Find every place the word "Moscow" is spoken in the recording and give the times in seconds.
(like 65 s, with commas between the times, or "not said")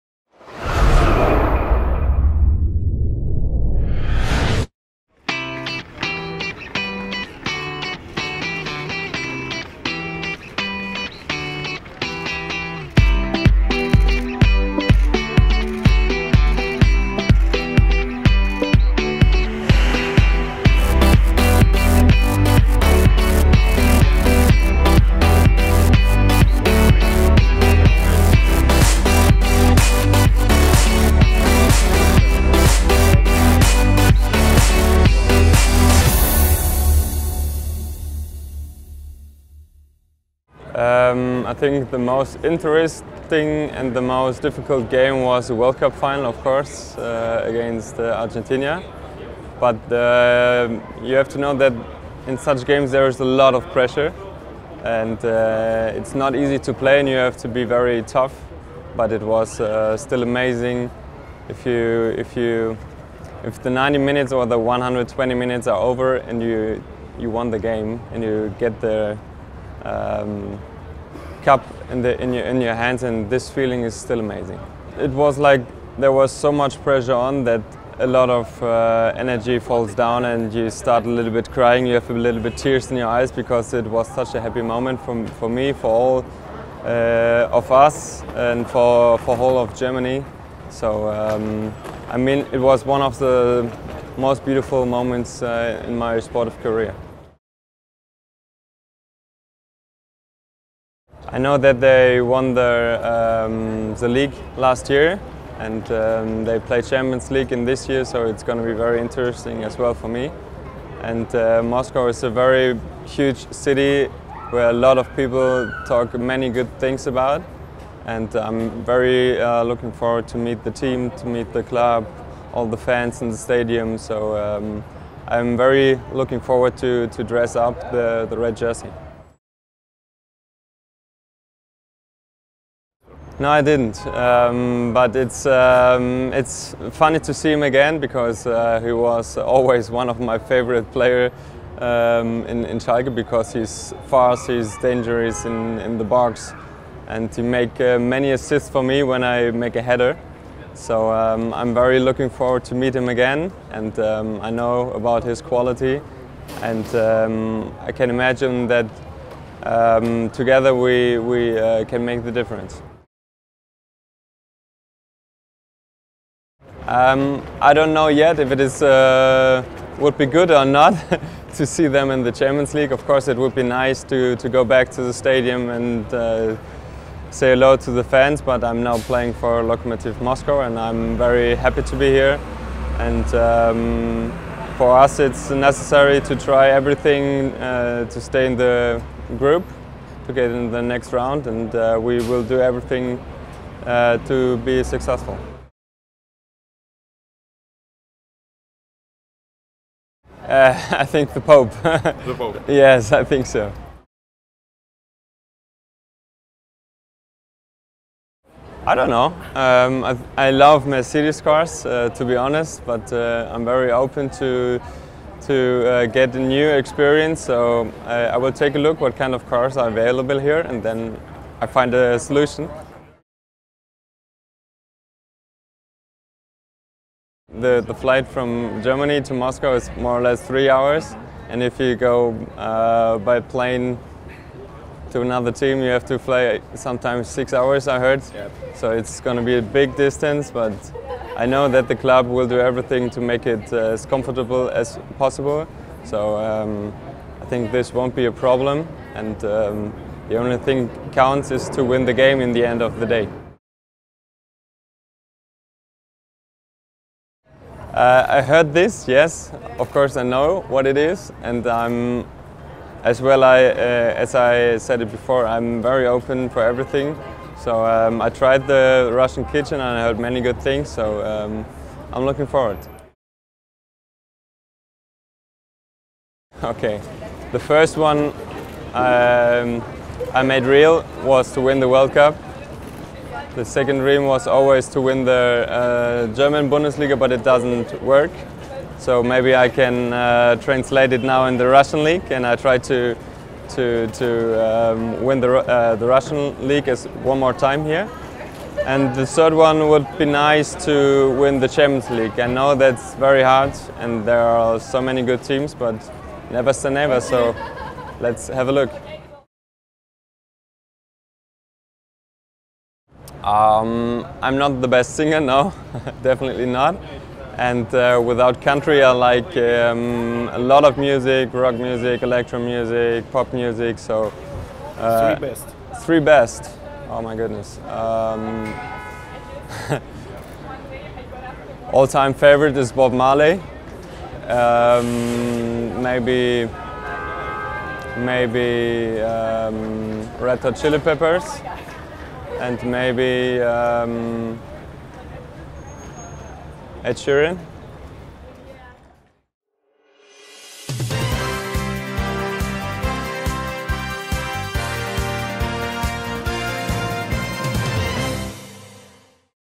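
111 s, 180 s, 229 s.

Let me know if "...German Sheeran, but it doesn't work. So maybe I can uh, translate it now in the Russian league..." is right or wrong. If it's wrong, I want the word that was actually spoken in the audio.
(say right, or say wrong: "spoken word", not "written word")
wrong: "Bundesliga", not "Sheeran".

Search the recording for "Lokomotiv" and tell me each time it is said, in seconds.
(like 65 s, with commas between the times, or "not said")
179 s.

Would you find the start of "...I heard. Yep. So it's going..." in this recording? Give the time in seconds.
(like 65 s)
237 s.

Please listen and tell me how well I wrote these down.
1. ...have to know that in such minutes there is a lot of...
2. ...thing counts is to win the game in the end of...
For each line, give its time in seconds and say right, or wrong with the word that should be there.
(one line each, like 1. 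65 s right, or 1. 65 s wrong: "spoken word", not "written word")
1. 51 s wrong: "games", not "minutes"
2. 250 s right.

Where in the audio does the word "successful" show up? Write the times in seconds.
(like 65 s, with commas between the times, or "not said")
194 s.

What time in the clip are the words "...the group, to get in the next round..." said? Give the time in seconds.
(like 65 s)
188 s.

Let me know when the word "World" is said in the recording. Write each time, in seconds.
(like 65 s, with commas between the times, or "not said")
45 s, 281 s.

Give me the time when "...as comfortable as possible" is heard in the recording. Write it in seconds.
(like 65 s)
243 s.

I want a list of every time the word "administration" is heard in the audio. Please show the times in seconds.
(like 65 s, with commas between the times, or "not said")
not said.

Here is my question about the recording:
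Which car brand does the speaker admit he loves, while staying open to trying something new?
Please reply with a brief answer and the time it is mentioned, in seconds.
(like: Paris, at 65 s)
Mercedes, at 210 s.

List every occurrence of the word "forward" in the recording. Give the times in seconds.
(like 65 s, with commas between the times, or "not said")
119 s, 126 s, 152 s, 272 s.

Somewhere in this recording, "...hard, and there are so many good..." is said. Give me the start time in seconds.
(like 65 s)
303 s.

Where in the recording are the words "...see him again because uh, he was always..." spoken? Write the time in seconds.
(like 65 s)
137 s.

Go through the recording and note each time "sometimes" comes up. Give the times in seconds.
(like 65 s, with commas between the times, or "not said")
236 s.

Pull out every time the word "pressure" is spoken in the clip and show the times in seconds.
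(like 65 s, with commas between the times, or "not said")
53 s, 76 s.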